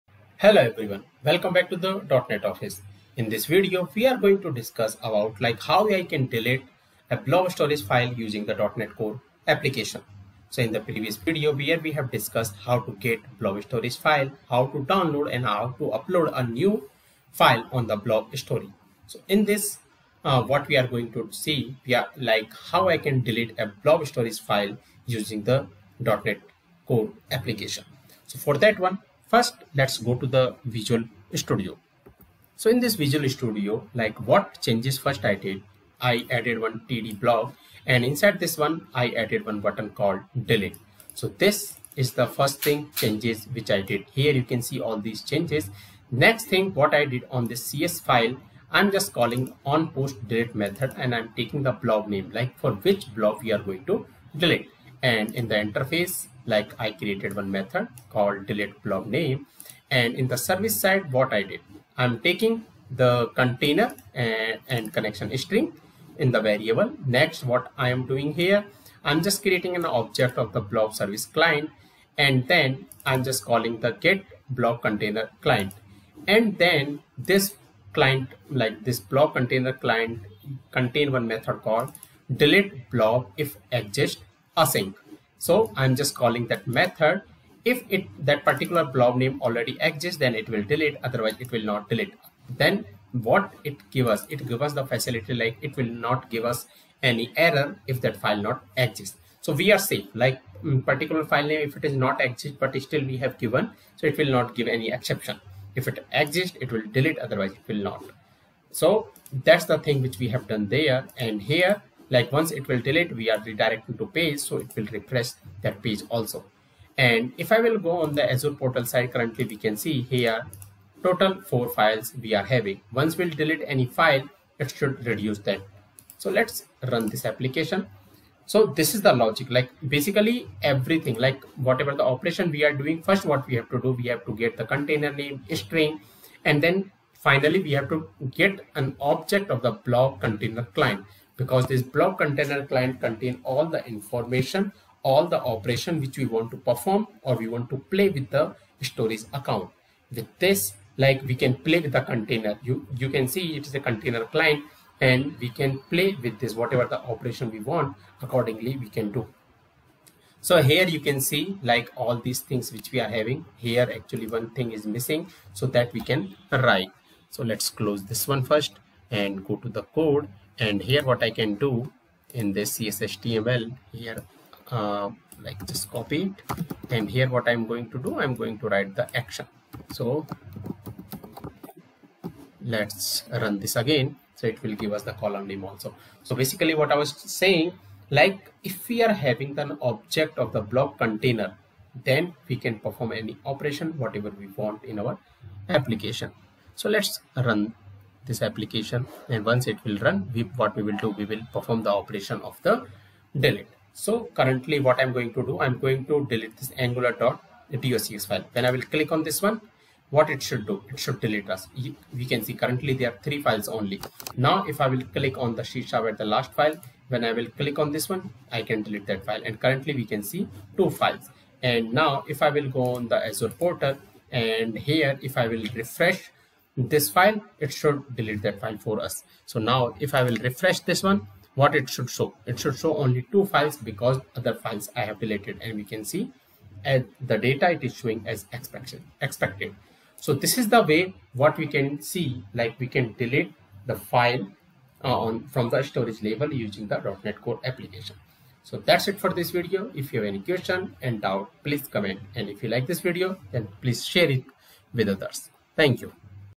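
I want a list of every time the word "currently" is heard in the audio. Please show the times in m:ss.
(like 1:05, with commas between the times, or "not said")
1:59, 3:24, 3:32, 3:39.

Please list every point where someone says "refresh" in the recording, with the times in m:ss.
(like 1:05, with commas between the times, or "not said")
1:54, 3:45, 3:50.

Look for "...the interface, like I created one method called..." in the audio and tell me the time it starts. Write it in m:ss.
0:55.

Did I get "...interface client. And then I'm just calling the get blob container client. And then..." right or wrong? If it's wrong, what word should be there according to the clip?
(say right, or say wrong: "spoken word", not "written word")
wrong: "service", not "interface".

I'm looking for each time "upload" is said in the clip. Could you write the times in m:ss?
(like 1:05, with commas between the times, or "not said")
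0:15.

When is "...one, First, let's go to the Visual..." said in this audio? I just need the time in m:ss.
0:28.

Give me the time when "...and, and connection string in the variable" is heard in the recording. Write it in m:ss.
1:04.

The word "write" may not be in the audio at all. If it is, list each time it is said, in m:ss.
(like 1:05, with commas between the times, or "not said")
2:46, 2:58.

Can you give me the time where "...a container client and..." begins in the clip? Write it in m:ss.
2:33.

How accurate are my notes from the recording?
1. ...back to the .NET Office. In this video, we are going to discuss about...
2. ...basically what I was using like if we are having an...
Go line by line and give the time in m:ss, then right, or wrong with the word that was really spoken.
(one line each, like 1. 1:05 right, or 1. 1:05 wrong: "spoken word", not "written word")
1. 0:01 right
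2. 3:06 wrong: "saying", not "using".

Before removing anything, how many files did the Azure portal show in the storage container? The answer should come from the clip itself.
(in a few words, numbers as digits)
4.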